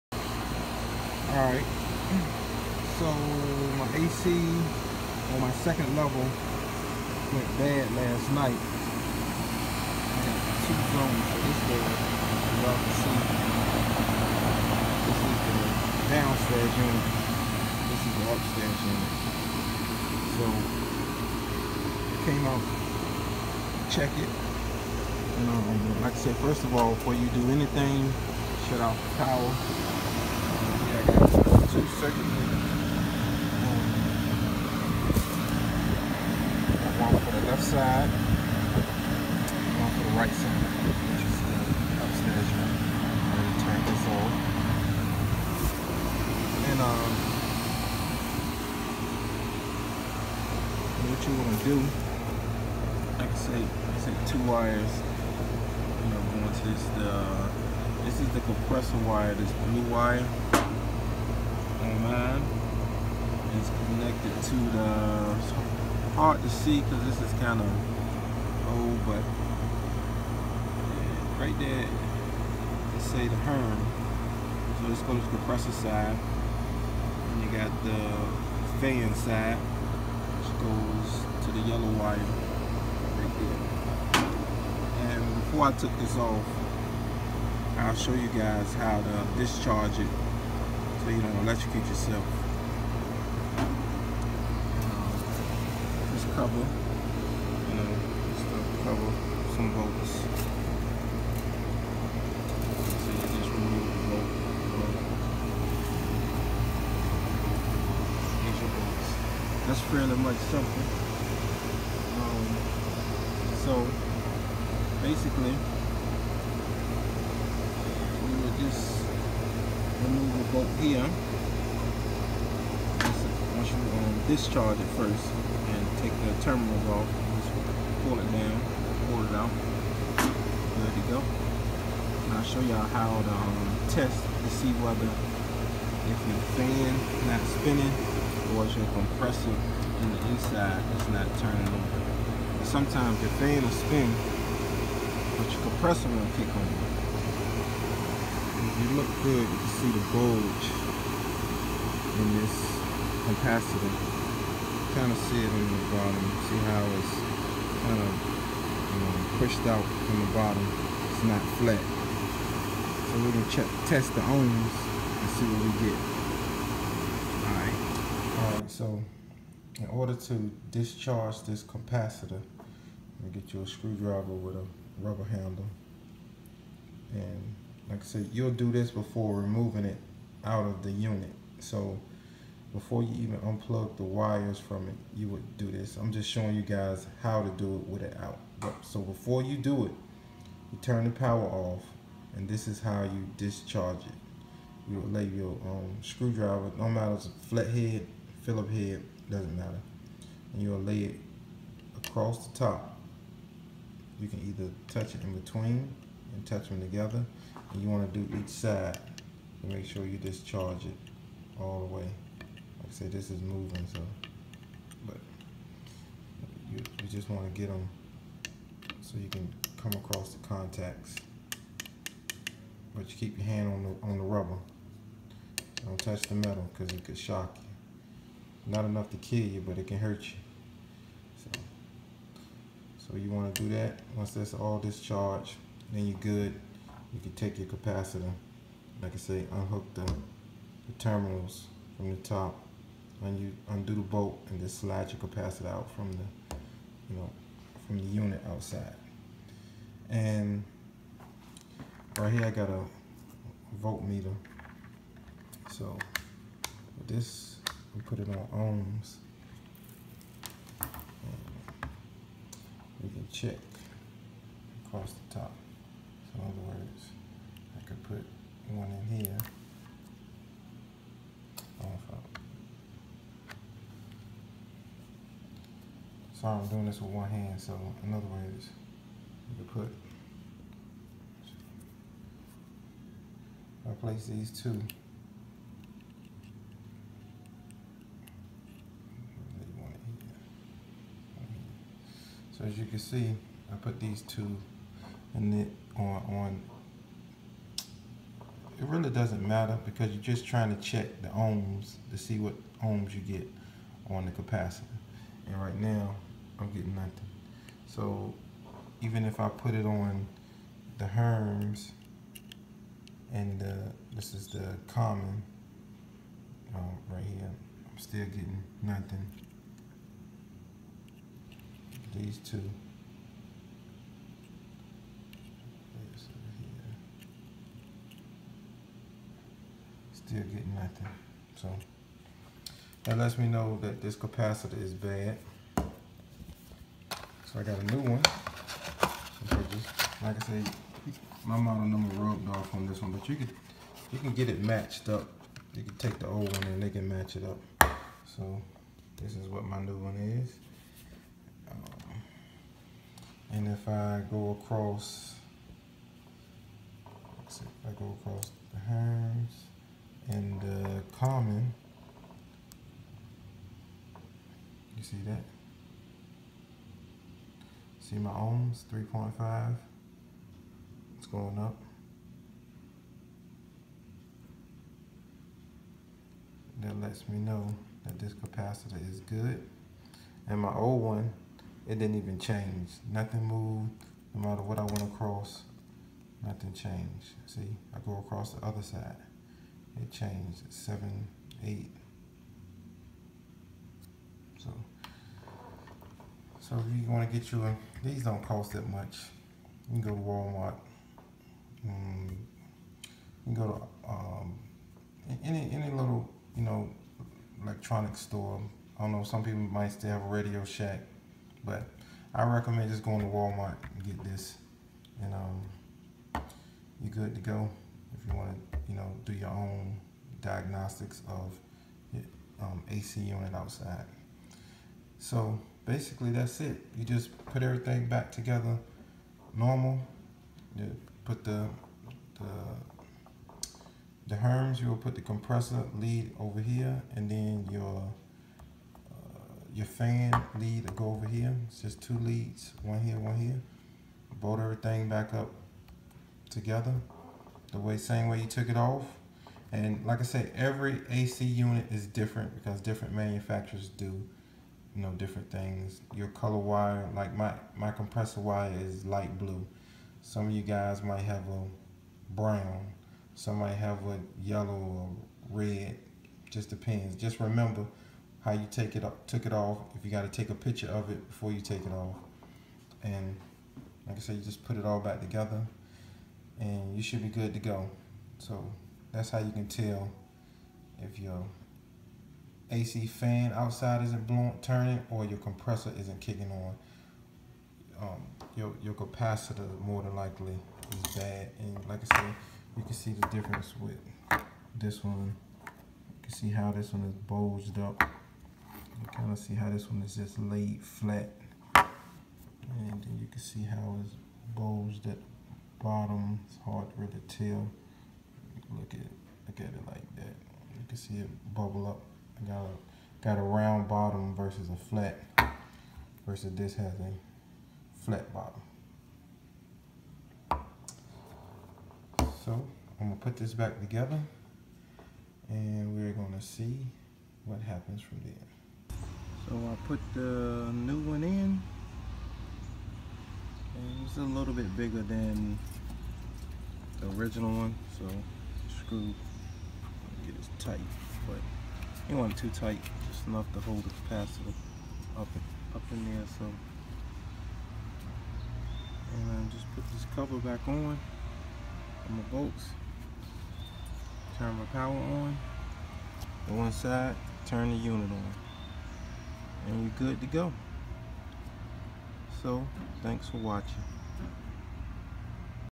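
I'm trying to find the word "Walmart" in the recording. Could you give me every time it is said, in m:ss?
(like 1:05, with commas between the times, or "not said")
6:40, 6:53.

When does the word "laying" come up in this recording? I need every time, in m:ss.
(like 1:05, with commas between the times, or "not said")
not said.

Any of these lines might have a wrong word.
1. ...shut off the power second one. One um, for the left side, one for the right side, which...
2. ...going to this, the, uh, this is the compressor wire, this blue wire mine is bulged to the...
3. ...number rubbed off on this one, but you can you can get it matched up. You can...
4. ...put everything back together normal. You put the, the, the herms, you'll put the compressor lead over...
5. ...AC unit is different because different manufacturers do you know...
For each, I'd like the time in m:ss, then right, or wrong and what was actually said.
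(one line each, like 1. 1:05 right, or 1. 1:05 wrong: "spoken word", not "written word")
1. 0:28 right
2. 0:56 wrong: "connected", not "bulged"
3. 5:41 right
4. 7:07 right
5. 7:31 right.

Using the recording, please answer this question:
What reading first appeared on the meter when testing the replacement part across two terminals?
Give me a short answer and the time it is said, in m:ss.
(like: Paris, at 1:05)
3.5, at 6:08.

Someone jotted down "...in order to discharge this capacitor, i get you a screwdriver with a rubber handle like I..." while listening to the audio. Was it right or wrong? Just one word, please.
right.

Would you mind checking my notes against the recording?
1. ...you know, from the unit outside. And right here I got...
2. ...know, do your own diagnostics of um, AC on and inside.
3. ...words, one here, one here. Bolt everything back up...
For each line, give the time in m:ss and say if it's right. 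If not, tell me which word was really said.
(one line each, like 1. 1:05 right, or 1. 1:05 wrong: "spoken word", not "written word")
1. 4:07 right
2. 6:58 wrong: "outside", not "inside"
3. 7:22 wrong: "leads", not "words".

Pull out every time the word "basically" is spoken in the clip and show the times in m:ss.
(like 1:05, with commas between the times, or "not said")
1:55, 7:05.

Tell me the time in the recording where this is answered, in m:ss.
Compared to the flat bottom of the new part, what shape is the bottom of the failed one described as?
8:33.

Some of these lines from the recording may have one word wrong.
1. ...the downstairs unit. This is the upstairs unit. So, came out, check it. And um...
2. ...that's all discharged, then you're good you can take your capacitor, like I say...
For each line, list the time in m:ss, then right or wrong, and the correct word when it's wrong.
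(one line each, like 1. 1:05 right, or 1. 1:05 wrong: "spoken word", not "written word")
1. 0:16 right
2. 3:54 right.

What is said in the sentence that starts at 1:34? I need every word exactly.
Um, just cover, you know, just cover some bolts.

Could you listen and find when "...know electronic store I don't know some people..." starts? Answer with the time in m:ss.
6:46.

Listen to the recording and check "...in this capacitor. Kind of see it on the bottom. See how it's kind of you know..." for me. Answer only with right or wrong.
right.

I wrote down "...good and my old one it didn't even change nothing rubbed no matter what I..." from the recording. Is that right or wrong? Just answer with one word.
wrong.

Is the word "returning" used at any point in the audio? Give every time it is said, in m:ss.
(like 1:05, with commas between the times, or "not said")
not said.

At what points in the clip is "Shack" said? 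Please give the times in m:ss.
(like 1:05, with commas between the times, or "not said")
6:50.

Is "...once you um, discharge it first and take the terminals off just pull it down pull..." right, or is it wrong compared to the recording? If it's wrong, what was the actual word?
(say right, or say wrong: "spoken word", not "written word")
right.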